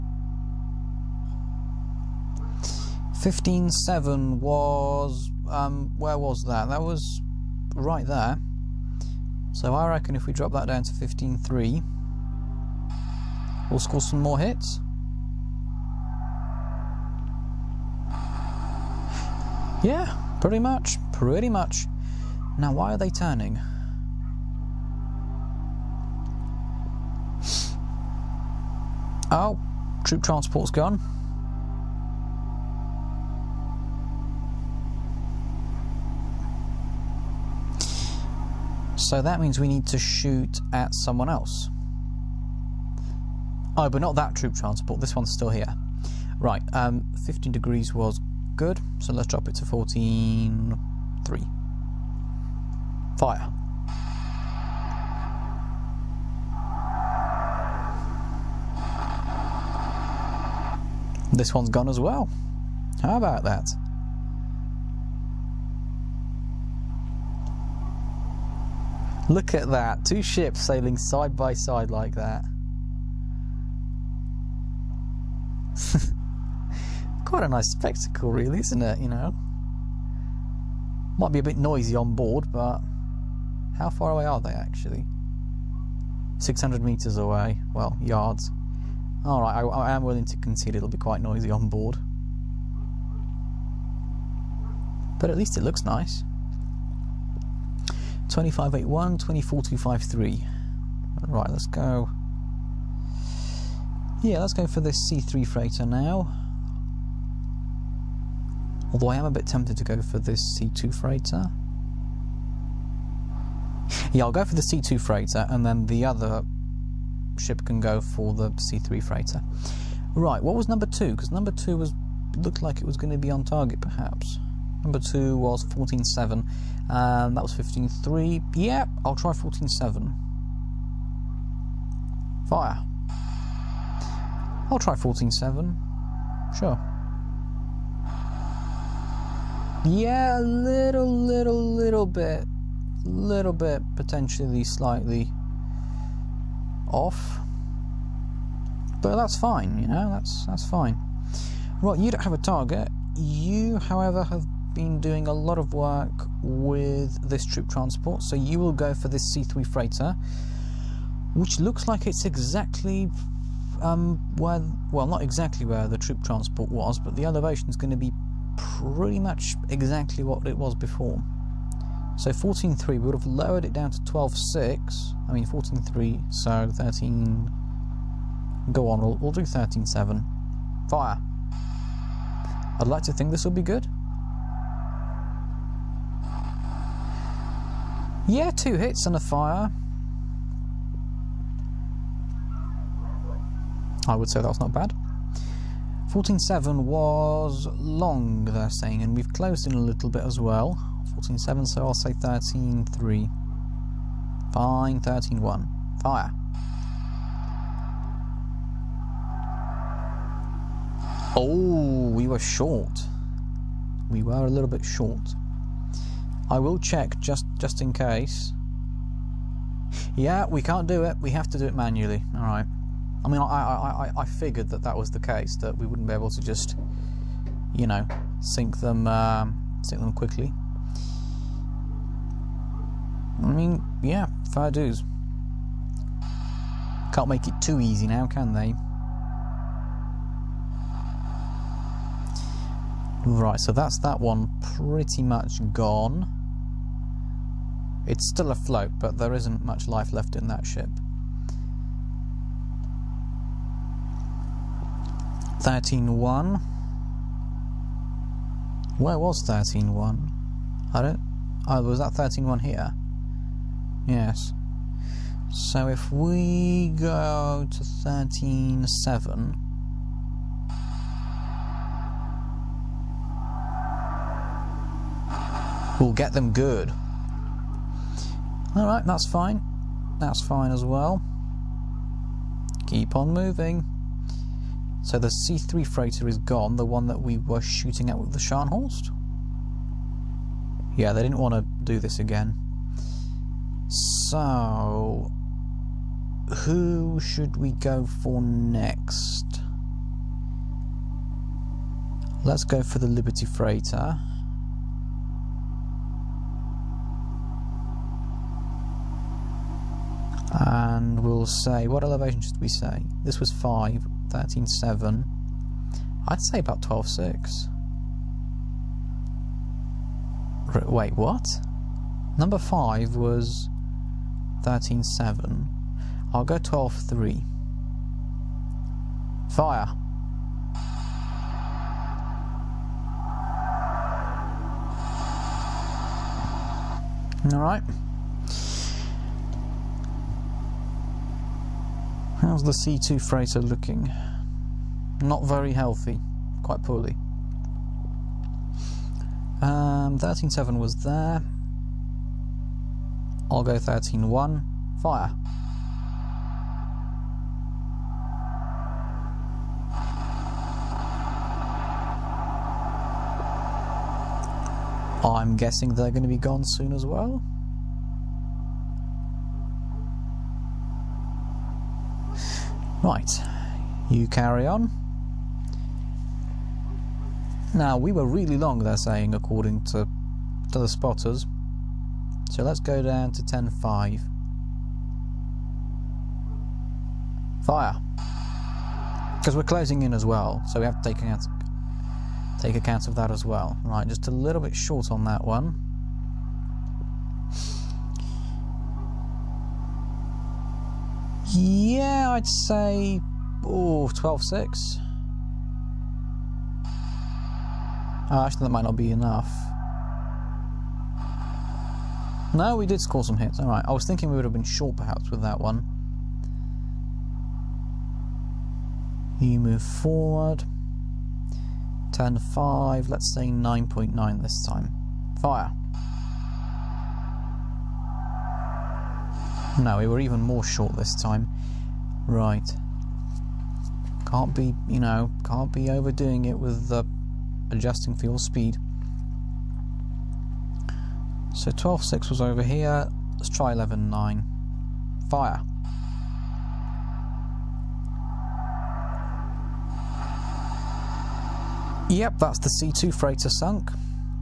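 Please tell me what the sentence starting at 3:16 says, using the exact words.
14.7 was long, they're saying, and we've closed in a little bit as well.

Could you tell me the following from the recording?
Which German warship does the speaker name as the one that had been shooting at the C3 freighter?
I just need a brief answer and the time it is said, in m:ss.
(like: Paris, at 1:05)
Scharnhorst, at 4:48.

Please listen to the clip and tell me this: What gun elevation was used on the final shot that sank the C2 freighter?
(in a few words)
11.9.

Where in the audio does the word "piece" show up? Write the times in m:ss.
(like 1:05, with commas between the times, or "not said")
not said.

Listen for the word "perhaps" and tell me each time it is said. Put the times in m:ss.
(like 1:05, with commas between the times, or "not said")
2:03, 6:54.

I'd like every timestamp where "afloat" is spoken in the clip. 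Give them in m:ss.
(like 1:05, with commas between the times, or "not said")
4:08.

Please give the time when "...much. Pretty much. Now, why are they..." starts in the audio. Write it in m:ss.
0:20.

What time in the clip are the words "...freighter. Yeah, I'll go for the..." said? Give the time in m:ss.
1:50.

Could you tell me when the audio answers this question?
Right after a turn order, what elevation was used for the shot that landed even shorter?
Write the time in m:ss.
7:03.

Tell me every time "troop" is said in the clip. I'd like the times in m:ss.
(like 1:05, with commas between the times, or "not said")
0:30, 0:44, 2:37, 2:45.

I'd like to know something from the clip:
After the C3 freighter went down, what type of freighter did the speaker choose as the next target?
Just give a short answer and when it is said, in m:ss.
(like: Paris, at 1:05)
Liberty Freighter, at 5:03.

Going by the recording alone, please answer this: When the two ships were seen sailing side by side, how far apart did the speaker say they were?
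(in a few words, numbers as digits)
600 yards.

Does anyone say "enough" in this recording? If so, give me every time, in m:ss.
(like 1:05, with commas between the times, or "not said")
6:49.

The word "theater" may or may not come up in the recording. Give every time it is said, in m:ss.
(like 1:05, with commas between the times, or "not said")
not said.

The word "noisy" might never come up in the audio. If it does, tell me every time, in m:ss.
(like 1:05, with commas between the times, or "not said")
1:21, 1:31.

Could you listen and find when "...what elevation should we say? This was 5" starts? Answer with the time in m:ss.
5:11.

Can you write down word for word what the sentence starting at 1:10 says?
Two ships sailing side by side like that.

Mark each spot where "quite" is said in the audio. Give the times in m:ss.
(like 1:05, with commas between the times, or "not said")
1:17, 1:30, 5:46.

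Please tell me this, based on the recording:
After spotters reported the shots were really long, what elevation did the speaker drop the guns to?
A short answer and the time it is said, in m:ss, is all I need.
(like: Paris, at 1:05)
10.5, at 6:23.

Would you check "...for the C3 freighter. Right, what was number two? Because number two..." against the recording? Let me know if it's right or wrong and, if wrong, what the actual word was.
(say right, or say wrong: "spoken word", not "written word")
right.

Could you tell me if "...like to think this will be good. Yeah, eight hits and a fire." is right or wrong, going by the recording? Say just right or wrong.
wrong.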